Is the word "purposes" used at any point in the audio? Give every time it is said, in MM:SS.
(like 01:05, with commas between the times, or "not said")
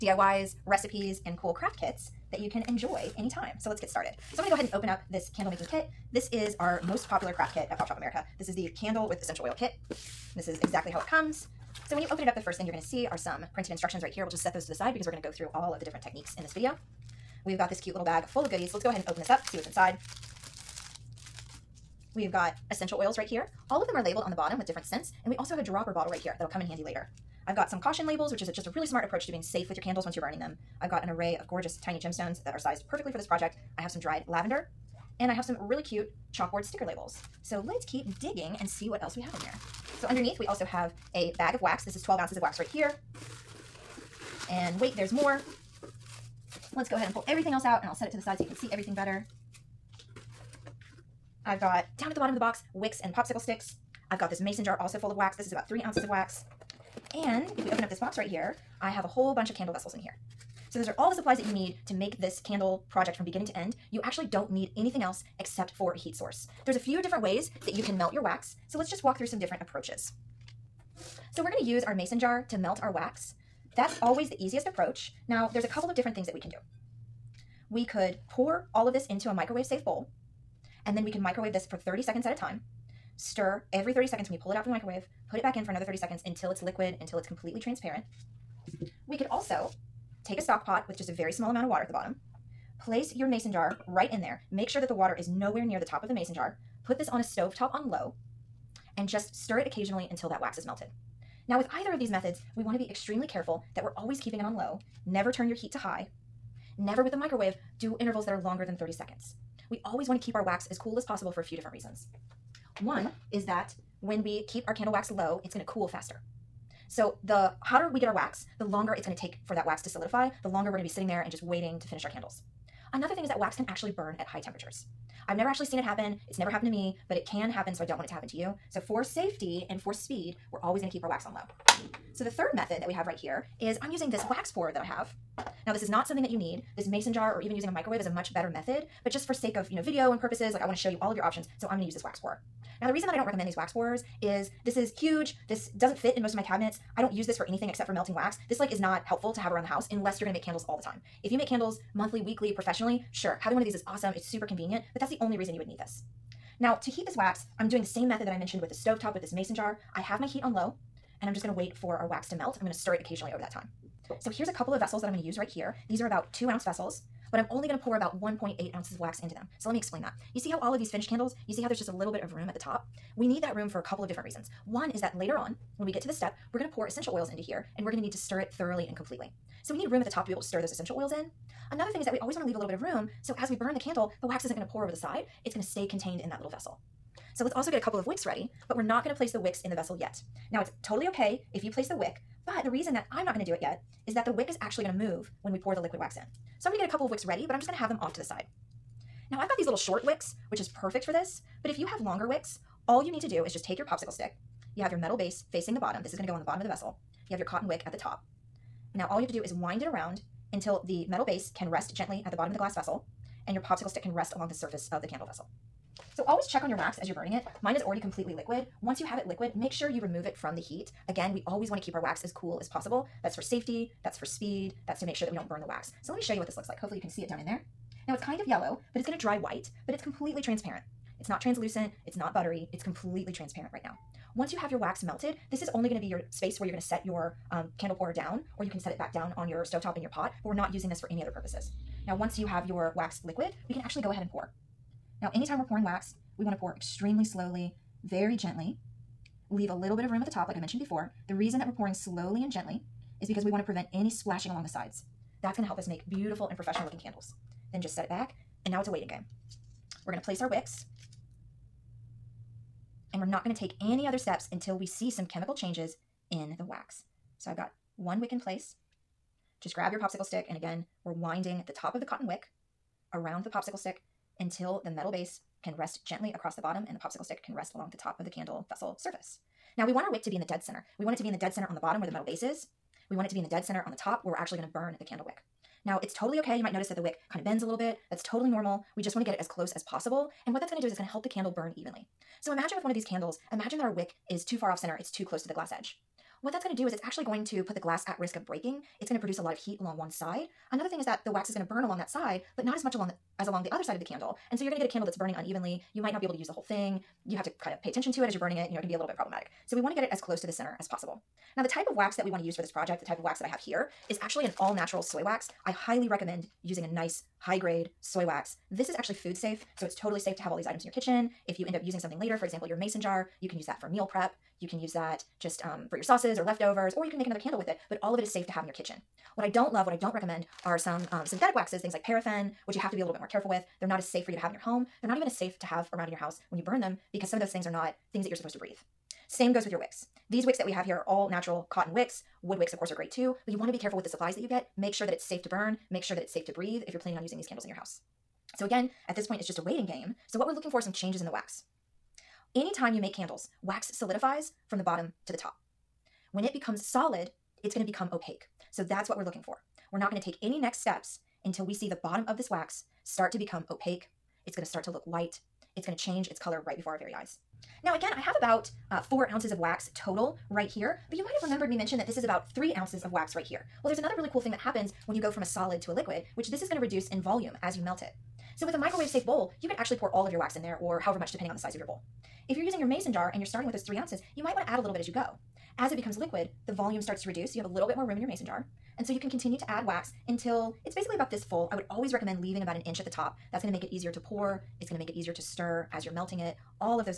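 02:20, 04:01.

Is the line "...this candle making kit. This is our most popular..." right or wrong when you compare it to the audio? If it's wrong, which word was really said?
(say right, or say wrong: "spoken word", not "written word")
right.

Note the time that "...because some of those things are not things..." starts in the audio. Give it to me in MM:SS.
05:37.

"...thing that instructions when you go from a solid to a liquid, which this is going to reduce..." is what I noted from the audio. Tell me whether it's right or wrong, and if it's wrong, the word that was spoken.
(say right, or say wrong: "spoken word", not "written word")
wrong: "happens", not "instructions".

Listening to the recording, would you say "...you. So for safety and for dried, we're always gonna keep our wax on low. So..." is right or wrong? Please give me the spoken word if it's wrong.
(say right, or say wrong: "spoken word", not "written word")
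wrong: "speed", not "dried".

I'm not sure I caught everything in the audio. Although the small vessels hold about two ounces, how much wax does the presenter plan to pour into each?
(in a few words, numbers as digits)
1.8 ounces.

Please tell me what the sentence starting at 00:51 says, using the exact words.
I've got down at the bottom of the box wicks and popsicle sticks.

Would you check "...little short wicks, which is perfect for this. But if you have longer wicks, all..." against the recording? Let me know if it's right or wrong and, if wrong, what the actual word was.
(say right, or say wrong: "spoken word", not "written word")
right.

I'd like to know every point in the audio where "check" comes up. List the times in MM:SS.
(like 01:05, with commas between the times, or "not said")
03:36.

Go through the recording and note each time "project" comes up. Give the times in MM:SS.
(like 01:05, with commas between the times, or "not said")
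00:33, 01:02, 05:12.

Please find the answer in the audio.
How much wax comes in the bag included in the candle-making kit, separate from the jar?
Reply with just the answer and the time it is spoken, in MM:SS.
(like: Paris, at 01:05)
12 ounces, at 00:42.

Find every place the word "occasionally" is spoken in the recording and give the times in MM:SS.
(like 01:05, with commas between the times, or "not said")
01:39, 02:43.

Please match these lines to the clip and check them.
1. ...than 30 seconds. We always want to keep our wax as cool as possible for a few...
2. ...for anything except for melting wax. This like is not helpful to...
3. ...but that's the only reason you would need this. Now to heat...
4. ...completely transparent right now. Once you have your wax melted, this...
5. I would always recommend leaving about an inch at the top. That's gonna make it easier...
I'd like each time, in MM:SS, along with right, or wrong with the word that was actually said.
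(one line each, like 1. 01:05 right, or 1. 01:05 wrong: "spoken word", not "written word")
1. 01:48 right
2. 02:27 right
3. 02:34 right
4. 03:52 right
5. 06:31 right.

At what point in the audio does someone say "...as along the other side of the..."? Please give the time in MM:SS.
05:03.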